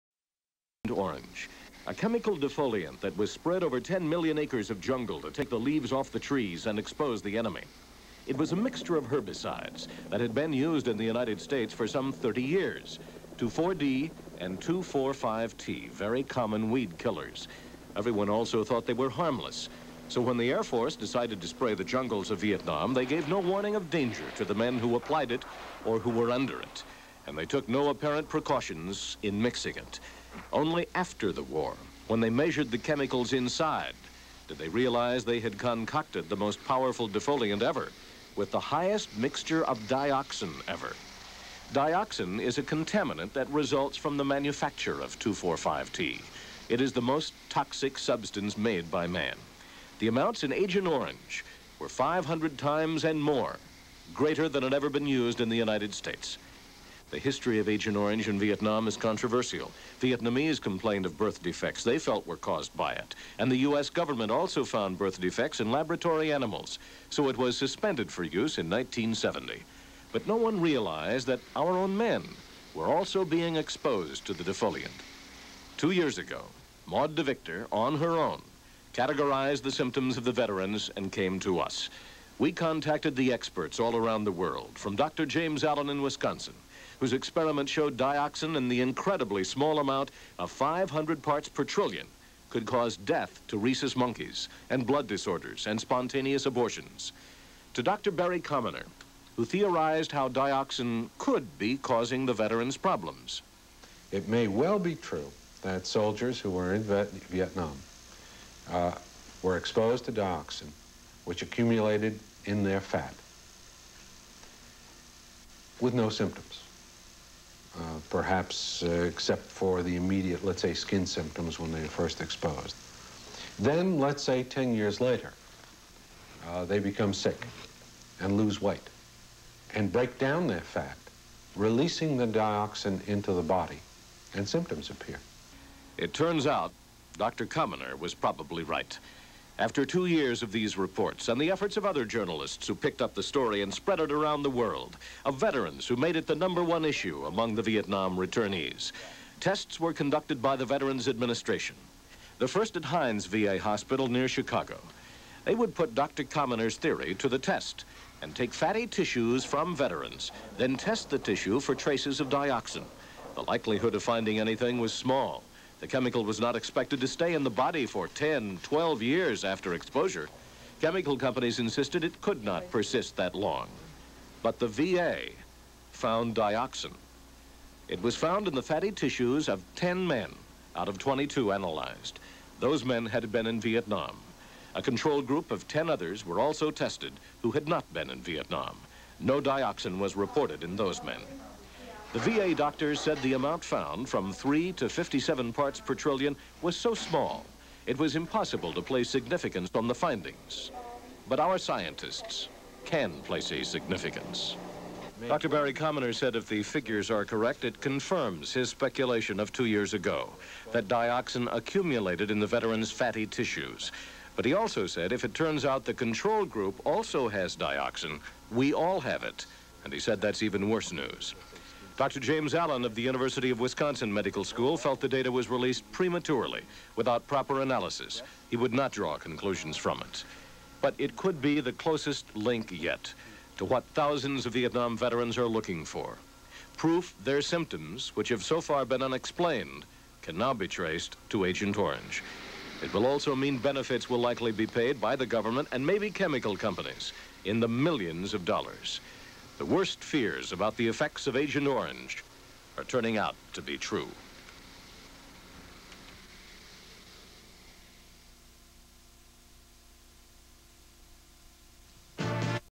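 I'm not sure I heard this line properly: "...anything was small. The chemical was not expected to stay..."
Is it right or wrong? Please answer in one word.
right.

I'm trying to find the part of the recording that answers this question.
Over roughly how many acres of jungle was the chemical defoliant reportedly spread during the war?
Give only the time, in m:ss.
0:03.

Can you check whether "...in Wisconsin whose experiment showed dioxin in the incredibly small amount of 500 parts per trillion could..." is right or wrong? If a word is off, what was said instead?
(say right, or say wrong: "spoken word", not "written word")
right.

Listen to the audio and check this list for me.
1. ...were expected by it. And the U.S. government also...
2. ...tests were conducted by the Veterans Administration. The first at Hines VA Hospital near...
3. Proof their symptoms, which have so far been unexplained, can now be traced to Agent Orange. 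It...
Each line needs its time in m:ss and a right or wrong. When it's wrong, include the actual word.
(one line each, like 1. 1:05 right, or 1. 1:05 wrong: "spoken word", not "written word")
1. 1:02 wrong: "caused", not "expected"
2. 2:29 right
3. 3:56 right.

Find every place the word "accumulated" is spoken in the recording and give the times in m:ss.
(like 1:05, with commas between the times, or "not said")
1:51, 3:31.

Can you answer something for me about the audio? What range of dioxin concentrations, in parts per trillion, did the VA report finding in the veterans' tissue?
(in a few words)
3 to 57.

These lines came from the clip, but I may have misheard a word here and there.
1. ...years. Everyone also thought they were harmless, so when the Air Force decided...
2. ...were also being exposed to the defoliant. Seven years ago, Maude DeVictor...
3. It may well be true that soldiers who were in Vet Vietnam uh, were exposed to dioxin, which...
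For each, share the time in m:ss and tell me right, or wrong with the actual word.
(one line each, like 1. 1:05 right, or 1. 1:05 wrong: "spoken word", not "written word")
1. 0:16 wrong: "killers", not "years"
2. 1:12 wrong: "Two", not "Seven"
3. 1:44 right.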